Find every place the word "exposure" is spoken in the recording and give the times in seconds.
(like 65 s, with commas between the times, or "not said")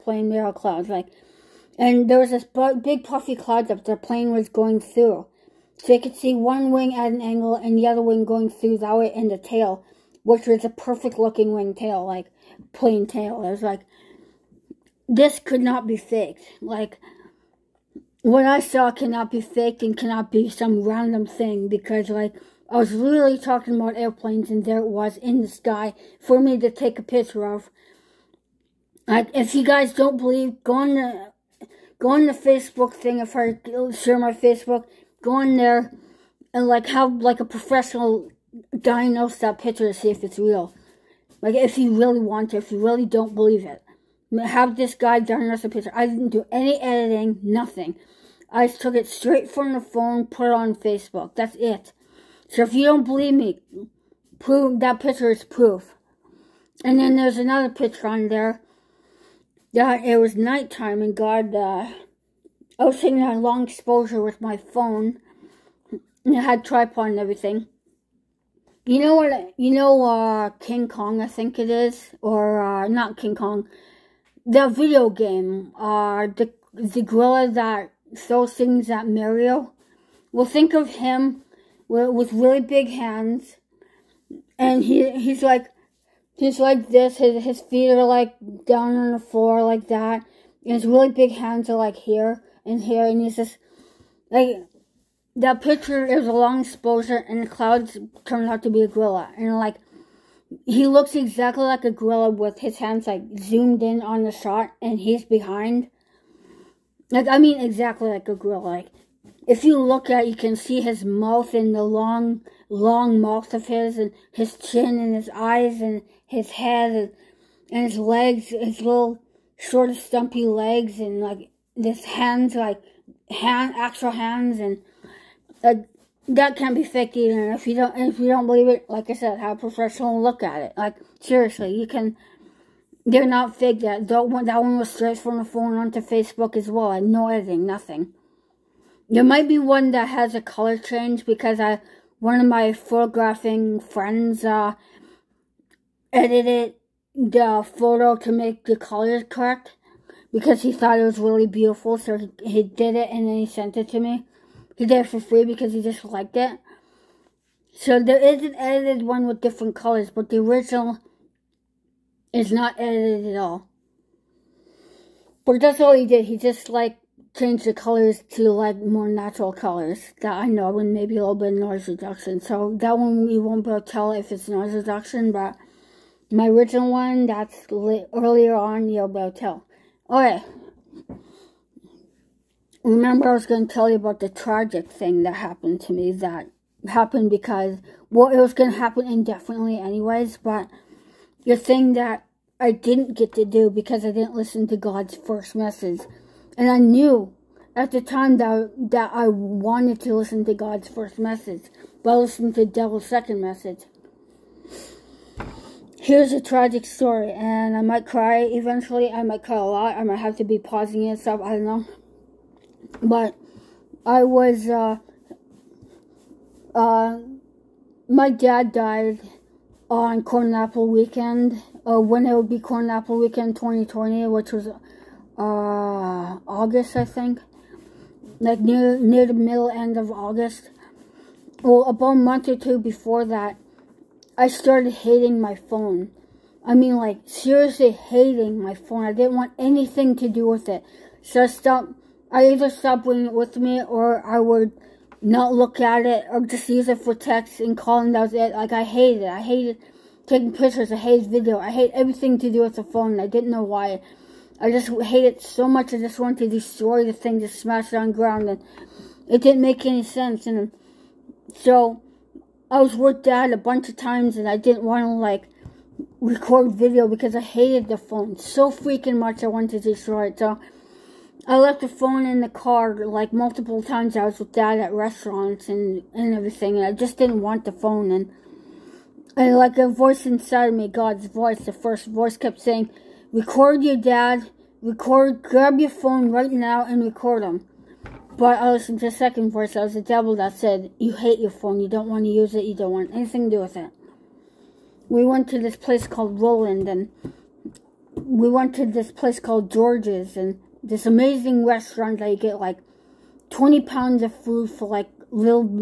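63 s, 96 s.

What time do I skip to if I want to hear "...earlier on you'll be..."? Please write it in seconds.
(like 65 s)
177 s.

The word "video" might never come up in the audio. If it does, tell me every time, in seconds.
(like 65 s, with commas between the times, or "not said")
74 s, 251 s, 266 s.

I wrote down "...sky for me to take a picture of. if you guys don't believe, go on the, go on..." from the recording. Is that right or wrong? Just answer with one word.
right.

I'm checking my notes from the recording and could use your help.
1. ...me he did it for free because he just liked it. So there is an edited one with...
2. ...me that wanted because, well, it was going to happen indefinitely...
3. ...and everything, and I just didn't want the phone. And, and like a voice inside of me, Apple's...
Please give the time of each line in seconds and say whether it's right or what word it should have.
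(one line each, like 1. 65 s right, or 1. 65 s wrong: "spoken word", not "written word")
1. 153 s right
2. 185 s wrong: "happened", not "wanted"
3. 276 s wrong: "God", not "Apple".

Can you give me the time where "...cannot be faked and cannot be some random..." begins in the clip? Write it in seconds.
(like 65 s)
18 s.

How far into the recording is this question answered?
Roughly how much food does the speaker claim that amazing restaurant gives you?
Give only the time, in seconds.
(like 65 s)
303 s.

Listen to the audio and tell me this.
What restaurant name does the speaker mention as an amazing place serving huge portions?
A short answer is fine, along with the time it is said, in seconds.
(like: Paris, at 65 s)
George's, at 299 s.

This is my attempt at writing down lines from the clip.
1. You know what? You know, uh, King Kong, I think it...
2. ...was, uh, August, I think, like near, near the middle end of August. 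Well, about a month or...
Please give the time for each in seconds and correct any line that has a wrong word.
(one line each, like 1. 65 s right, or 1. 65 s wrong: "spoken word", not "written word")
1. 68 s right
2. 224 s right.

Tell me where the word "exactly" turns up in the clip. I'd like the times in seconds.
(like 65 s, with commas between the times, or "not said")
101 s, 107 s.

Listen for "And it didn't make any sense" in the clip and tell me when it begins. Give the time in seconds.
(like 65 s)
258 s.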